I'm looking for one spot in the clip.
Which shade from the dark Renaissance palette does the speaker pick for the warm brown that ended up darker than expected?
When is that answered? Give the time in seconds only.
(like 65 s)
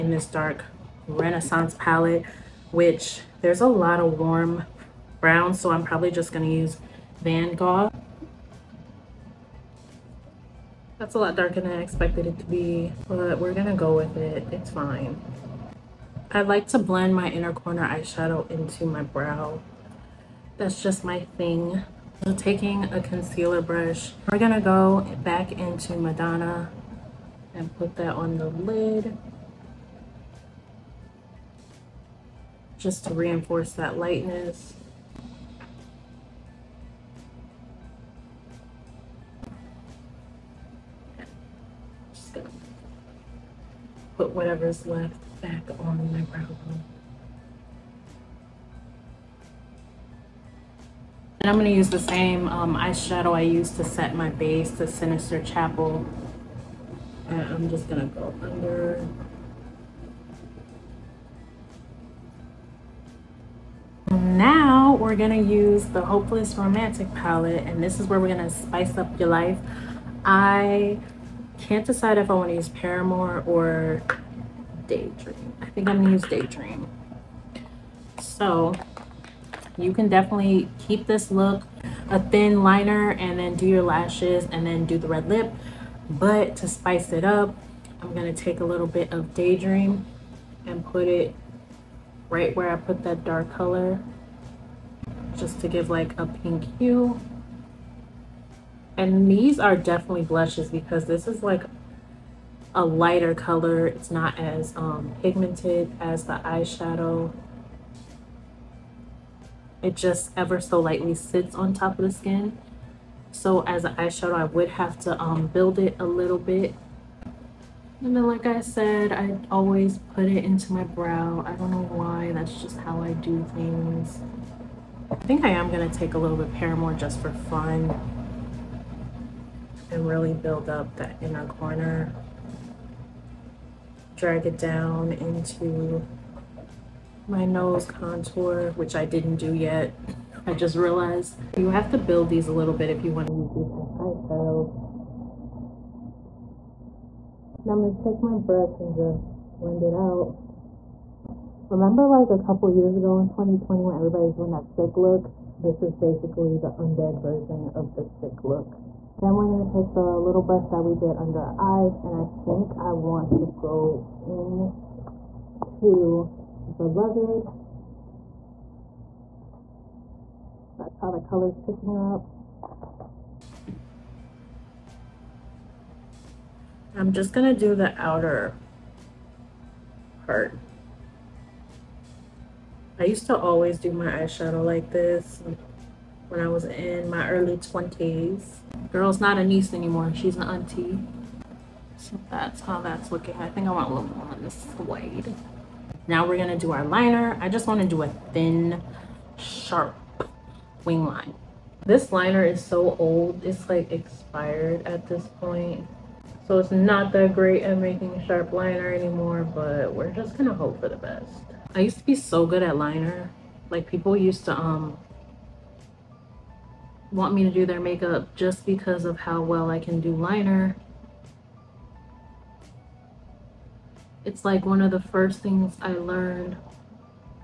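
7 s.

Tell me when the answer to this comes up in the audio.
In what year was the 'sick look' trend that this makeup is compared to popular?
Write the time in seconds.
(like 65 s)
153 s.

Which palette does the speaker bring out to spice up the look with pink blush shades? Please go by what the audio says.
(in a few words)
Hopeless Romantic.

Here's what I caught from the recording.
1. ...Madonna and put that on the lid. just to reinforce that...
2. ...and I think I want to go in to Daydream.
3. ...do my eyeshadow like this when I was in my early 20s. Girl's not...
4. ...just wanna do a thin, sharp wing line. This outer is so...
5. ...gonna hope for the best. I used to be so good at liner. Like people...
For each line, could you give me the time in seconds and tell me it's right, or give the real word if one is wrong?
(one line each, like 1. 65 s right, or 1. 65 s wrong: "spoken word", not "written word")
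1. 25 s right
2. 162 s wrong: "Beloved", not "Daydream"
3. 183 s right
4. 197 s wrong: "liner", not "outer"
5. 210 s right.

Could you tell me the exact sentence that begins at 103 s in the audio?
It's not as um, pigmented as the eyeshadow.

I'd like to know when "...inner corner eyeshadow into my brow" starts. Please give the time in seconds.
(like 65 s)
17 s.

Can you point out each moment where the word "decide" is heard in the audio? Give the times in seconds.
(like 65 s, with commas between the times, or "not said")
71 s.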